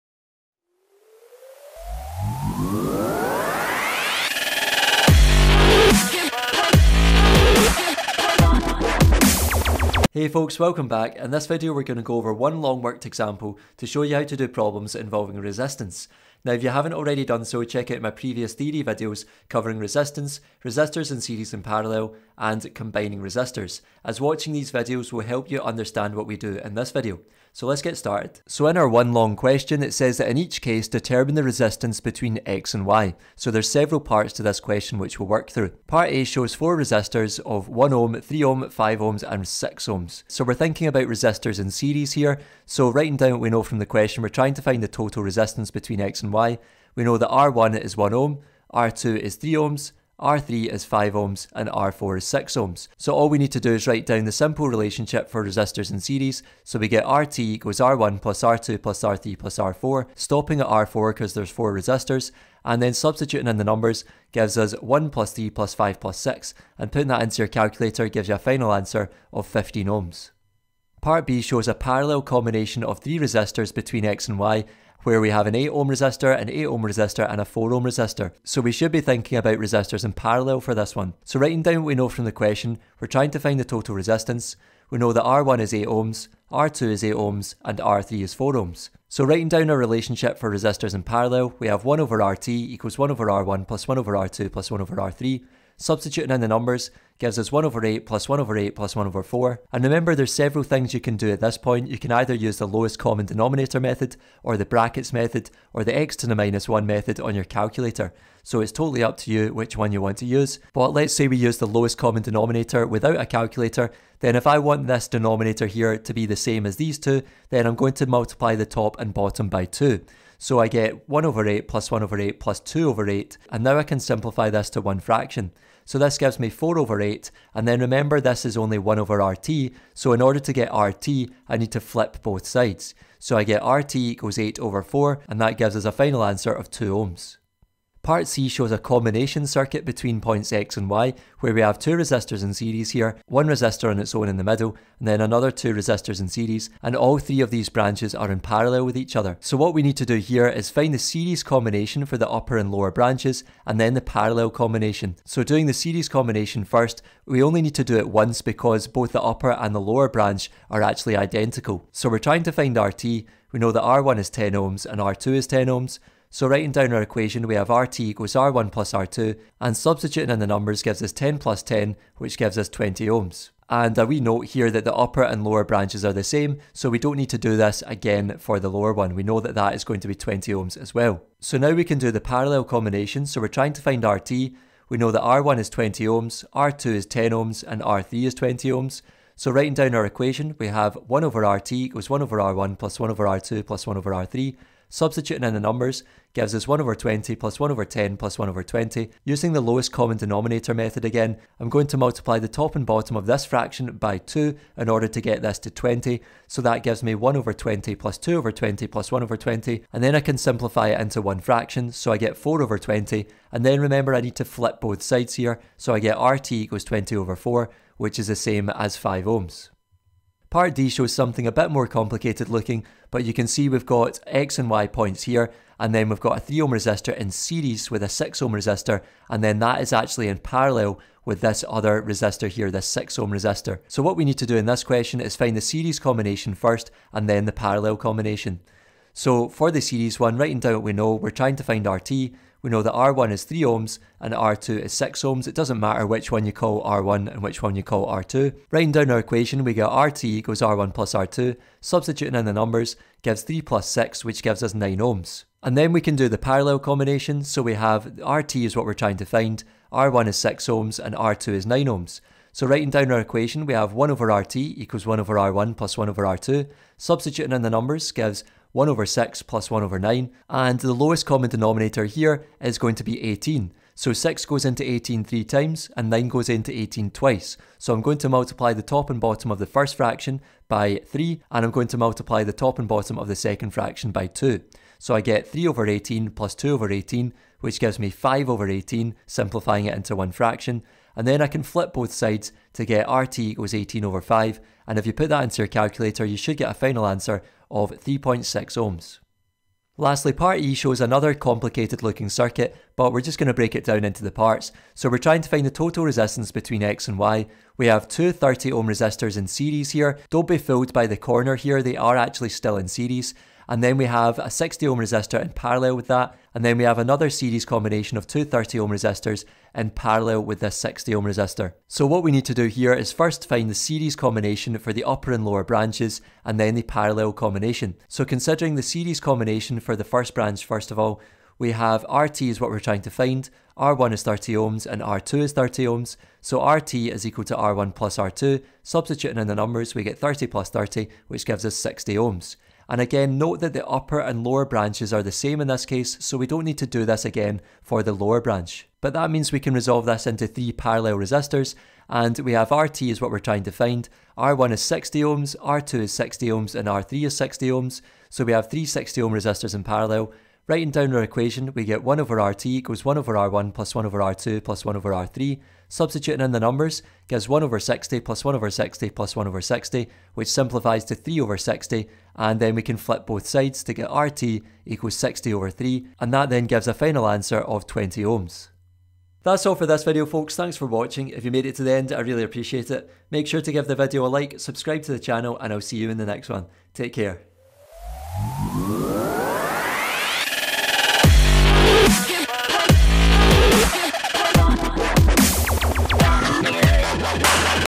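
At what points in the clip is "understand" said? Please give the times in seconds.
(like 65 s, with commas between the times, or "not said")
25 s.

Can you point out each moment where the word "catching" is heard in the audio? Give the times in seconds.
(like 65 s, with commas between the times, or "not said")
not said.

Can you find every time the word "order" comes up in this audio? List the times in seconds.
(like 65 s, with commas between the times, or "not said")
130 s, 204 s.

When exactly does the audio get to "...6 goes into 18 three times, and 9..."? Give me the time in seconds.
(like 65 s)
274 s.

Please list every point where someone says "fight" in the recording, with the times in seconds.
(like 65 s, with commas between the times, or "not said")
not said.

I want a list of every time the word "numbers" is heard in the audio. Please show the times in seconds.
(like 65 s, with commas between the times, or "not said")
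63 s, 96 s, 170 s, 195 s, 252 s, 267 s, 339 s, 366 s.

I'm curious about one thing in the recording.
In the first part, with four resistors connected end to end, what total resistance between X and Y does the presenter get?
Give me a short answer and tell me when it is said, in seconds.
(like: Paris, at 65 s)
15 ohms, at 69 s.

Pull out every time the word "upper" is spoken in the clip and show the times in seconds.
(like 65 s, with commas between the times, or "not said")
152 s, 159 s, 174 s, 325 s, 343 s.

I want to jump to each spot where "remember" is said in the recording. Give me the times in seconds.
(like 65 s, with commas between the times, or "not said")
99 s, 127 s, 213 s.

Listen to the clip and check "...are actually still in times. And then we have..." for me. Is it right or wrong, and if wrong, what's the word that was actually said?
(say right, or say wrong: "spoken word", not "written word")
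wrong: "series", not "times".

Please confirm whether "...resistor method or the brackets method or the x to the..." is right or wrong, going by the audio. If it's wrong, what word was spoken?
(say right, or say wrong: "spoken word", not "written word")
wrong: "denominator", not "resistor".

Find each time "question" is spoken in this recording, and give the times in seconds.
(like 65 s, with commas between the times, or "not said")
29 s, 34 s, 43 s, 82 s, 234 s.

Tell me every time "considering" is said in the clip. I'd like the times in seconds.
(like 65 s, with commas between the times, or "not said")
328 s.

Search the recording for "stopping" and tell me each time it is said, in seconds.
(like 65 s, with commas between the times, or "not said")
60 s.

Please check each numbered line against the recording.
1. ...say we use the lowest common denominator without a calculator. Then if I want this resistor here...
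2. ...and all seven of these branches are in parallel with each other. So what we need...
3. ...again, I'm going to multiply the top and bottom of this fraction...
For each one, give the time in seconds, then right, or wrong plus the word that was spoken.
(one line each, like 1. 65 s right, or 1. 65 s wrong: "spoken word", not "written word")
1. 111 s wrong: "denominator", not "resistor"
2. 146 s wrong: "three", not "seven"
3. 201 s right.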